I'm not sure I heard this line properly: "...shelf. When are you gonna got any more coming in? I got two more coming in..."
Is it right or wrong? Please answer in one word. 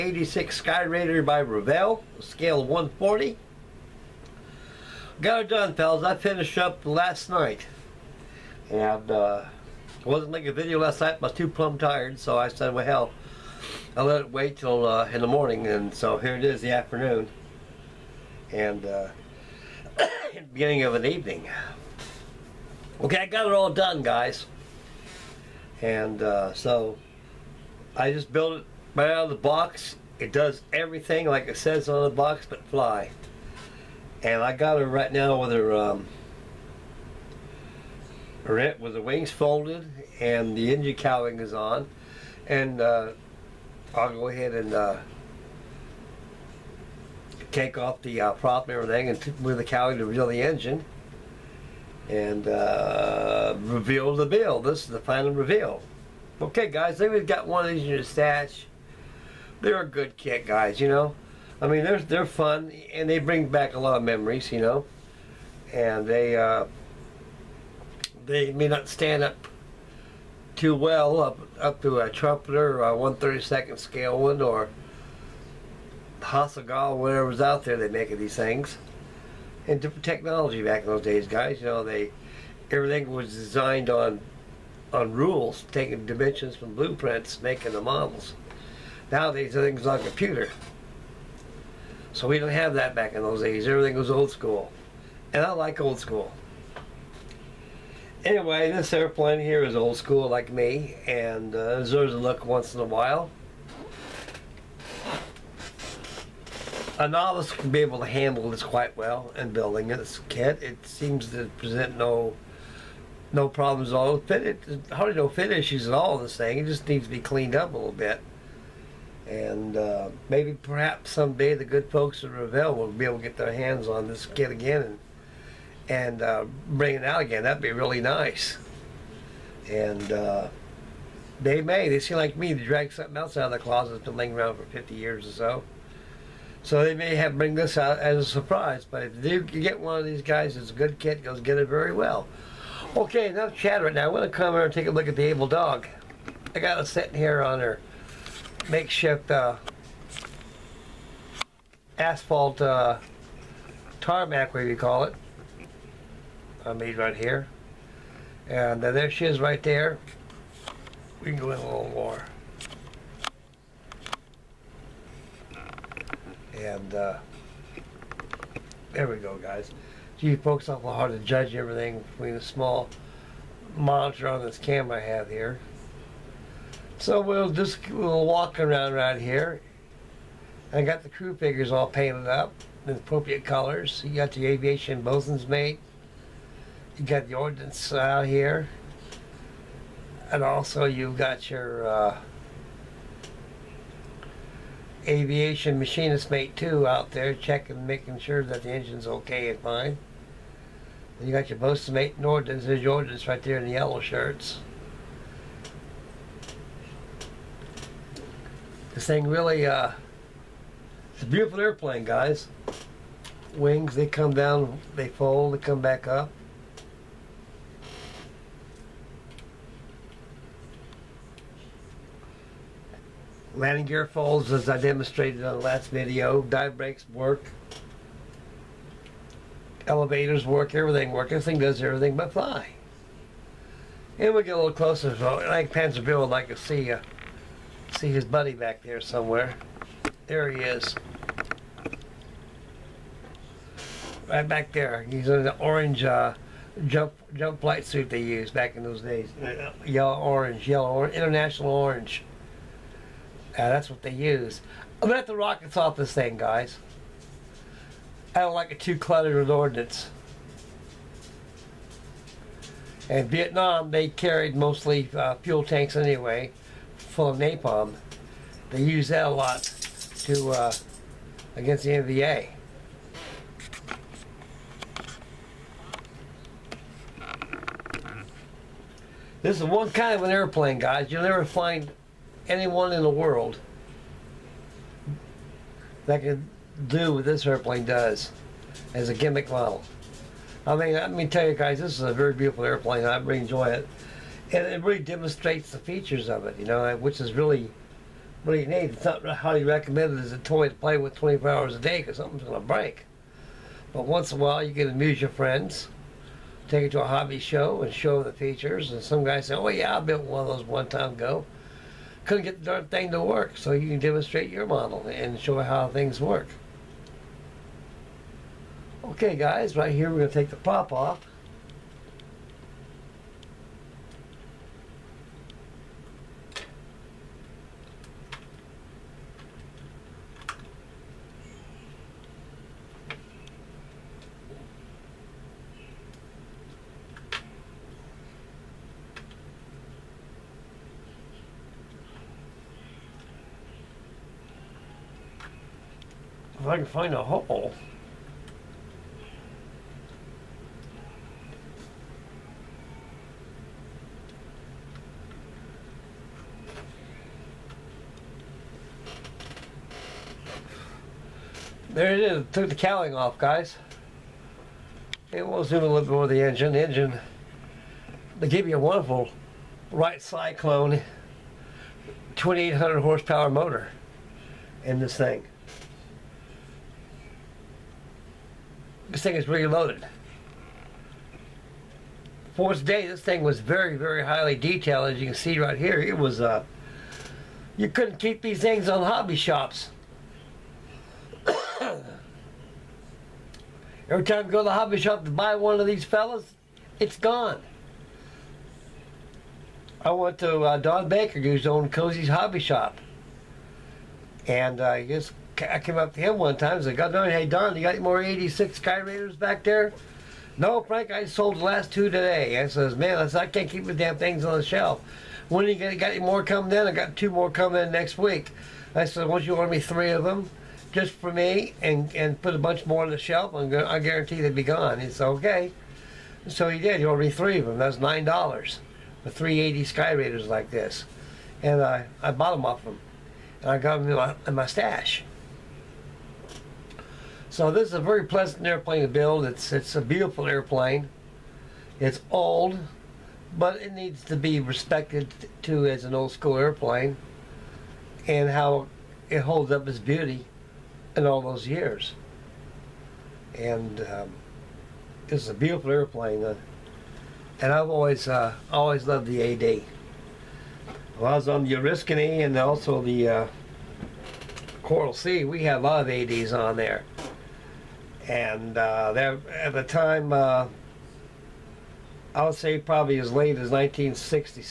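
right.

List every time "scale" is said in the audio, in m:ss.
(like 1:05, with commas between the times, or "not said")
0:02, 1:13.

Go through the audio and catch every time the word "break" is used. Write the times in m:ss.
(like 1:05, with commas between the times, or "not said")
5:02.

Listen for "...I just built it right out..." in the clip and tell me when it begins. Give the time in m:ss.
0:27.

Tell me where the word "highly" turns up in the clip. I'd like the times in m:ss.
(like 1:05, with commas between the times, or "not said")
4:59, 6:24.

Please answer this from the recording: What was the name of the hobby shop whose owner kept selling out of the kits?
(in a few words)
Cozy's Hobby Shop.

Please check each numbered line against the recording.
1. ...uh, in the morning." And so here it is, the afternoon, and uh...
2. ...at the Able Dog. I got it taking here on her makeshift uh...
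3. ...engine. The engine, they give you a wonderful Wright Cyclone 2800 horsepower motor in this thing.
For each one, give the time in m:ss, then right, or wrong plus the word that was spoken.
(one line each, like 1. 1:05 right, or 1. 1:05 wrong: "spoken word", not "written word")
1. 0:14 right
2. 2:25 wrong: "sitting", not "taking"
3. 6:06 right.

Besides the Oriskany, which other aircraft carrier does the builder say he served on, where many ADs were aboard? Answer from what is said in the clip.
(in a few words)
Coral Sea.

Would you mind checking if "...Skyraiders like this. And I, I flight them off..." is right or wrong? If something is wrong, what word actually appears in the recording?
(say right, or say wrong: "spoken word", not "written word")
wrong: "bought", not "flight".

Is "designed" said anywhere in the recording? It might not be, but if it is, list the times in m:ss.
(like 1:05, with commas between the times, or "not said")
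1:23.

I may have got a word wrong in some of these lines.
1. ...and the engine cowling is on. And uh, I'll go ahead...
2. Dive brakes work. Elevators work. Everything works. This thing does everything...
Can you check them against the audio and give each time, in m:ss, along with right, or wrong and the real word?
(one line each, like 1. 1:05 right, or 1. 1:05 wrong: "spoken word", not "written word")
1. 0:40 right
2. 3:46 right.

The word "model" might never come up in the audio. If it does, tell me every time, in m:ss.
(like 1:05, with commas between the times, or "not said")
1:27, 4:49, 5:14.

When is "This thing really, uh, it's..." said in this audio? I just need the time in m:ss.
3:28.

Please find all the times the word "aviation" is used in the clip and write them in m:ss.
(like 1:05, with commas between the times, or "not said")
3:04, 3:15.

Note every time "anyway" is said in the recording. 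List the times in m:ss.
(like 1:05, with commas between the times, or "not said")
1:38, 4:25.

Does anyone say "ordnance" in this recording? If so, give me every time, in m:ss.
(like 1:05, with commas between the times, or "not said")
3:07, 3:22, 4:19.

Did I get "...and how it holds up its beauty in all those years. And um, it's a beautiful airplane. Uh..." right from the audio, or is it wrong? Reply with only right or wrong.
right.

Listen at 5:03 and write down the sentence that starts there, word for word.
But once in a while, you can amuse your friends, take it to a hobby show and show the features.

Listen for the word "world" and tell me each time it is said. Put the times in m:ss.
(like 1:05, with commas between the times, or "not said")
4:43.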